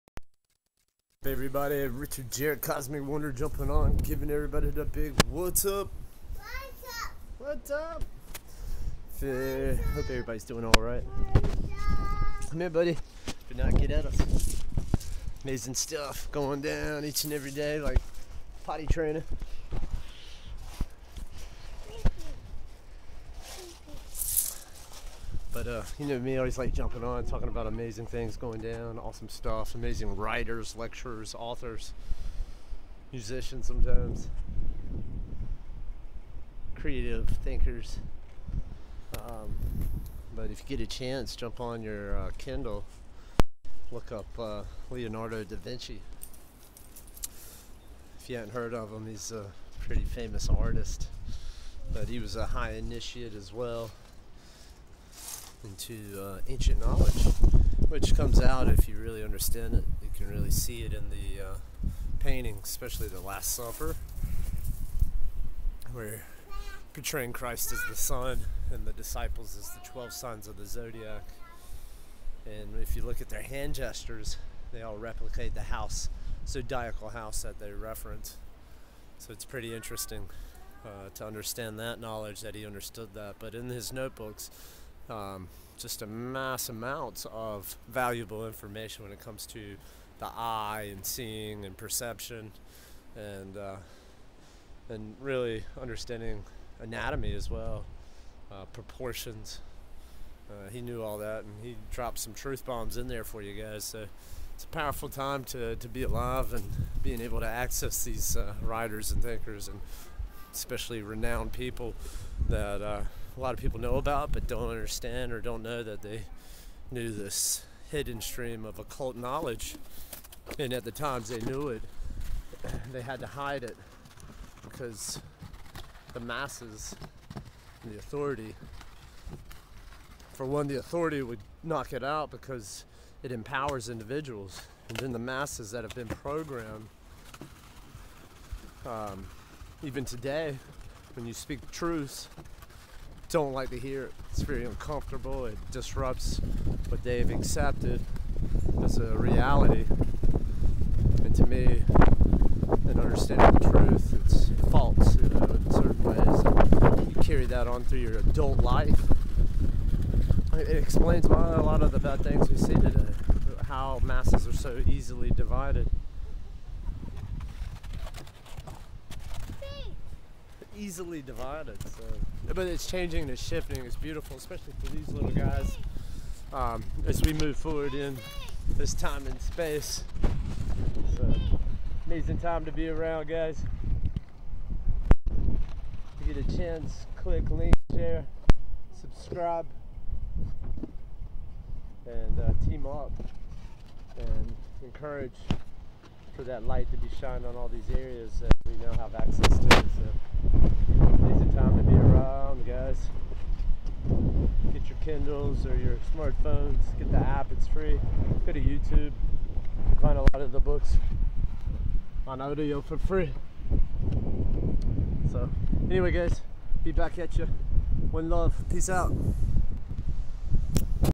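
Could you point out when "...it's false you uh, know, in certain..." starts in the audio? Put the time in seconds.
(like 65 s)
154 s.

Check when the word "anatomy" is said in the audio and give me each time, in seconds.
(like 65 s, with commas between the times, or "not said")
96 s.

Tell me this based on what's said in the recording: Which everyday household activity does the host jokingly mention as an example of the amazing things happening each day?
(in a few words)
Potty training.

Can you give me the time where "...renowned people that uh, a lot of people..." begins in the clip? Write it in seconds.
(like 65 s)
111 s.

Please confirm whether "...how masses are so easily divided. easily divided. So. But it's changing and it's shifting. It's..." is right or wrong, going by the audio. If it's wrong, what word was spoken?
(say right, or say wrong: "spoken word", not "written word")
right.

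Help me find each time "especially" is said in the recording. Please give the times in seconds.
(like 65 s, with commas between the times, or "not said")
62 s, 110 s, 174 s.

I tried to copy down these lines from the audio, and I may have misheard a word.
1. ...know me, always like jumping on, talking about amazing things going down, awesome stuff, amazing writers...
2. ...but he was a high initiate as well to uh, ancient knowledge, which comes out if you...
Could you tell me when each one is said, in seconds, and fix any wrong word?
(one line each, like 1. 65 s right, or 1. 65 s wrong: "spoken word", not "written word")
1. 26 s right
2. 51 s right.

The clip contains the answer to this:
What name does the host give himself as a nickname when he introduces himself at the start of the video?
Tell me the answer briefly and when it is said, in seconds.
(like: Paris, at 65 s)
Cosmic Wanderer, at 2 s.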